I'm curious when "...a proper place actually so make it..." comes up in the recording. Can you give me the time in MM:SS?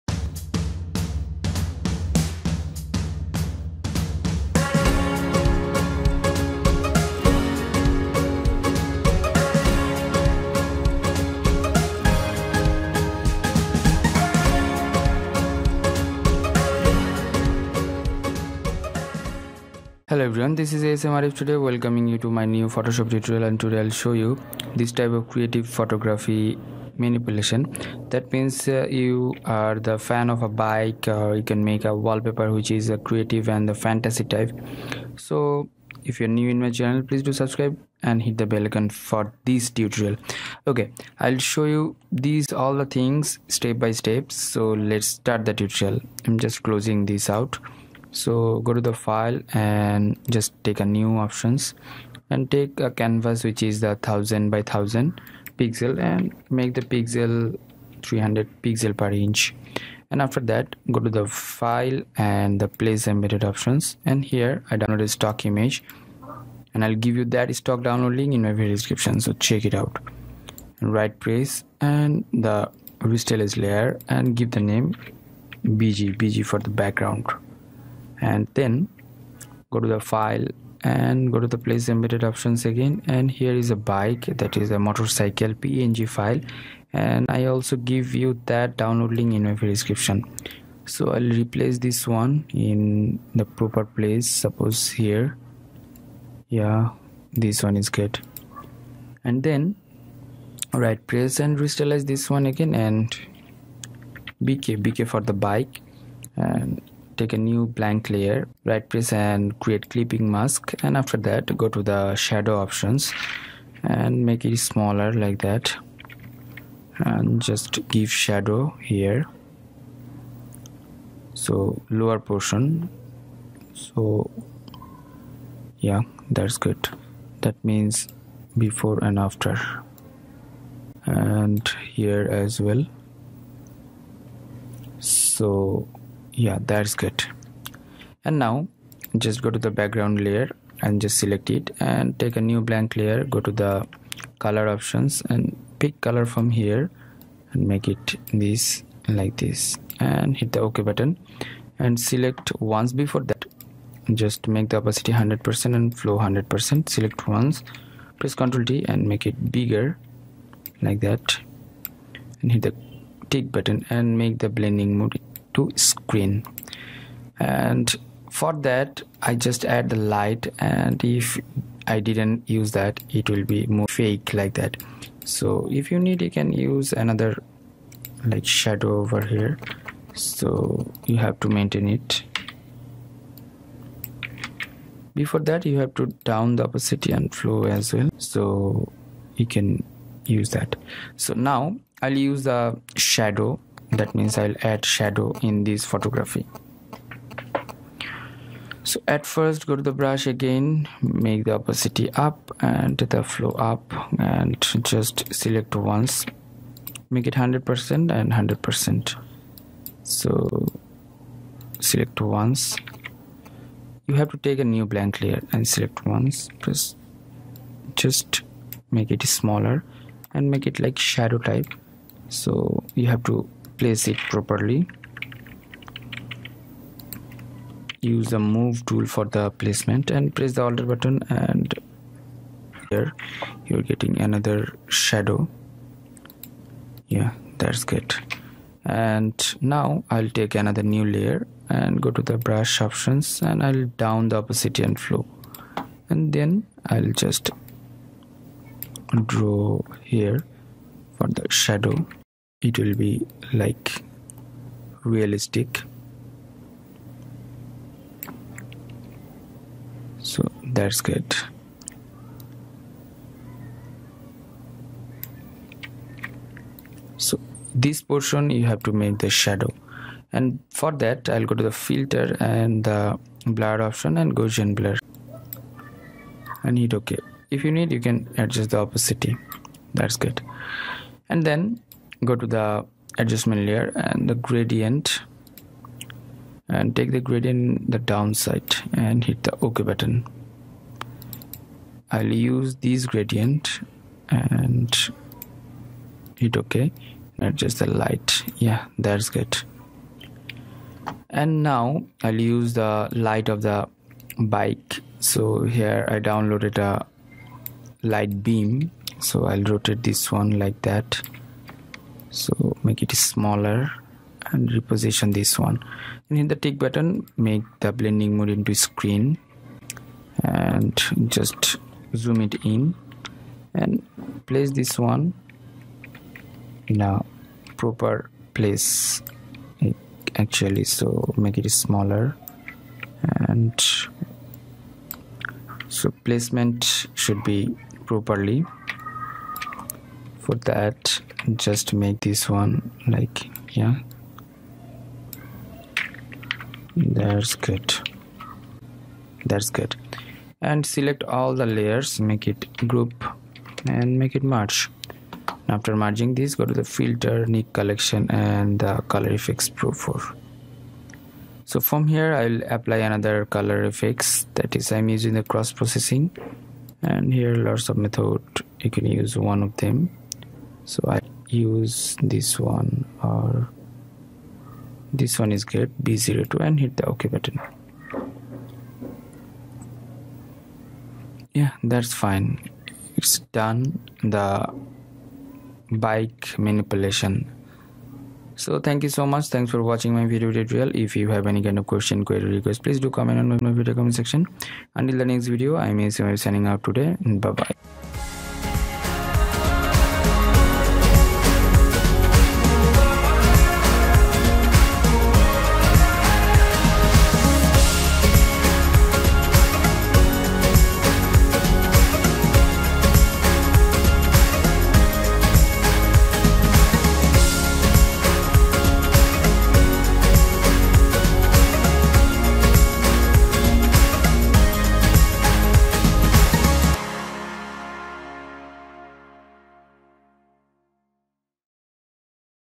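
05:27.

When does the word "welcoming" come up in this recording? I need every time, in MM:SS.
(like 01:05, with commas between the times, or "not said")
00:21.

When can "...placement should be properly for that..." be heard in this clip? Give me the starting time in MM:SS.
05:36.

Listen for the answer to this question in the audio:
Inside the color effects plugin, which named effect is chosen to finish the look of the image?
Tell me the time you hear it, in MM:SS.
06:05.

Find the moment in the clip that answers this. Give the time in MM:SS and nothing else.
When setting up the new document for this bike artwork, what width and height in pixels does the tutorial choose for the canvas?
00:53.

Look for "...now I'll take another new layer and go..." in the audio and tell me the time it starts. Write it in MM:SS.
03:59.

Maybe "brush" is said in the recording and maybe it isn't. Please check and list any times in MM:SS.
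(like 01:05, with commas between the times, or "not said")
03:19, 04:02.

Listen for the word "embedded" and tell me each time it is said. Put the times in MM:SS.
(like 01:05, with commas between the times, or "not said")
01:03, 01:21.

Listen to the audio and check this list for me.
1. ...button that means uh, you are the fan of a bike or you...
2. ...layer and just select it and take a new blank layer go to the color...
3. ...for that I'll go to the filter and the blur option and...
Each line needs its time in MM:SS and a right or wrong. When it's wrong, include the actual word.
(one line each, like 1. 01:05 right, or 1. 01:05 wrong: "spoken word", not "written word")
1. 00:27 wrong: "manipulation", not "button"
2. 02:20 right
3. 04:30 right.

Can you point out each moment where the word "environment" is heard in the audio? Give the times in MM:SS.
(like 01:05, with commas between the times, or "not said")
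not said.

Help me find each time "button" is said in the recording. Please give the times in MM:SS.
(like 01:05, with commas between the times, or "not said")
02:30, 02:43, 03:50, 04:49, 05:16, 06:17.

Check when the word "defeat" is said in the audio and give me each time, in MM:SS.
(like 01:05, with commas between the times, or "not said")
not said.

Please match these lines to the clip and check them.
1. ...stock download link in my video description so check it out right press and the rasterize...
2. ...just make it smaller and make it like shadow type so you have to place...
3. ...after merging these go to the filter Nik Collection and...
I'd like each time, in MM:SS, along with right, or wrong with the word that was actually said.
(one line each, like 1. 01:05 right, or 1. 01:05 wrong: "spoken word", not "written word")
1. 01:07 right
2. 03:37 right
3. 05:55 right.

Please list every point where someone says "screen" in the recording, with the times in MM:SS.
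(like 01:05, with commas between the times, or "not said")
02:45, 05:18.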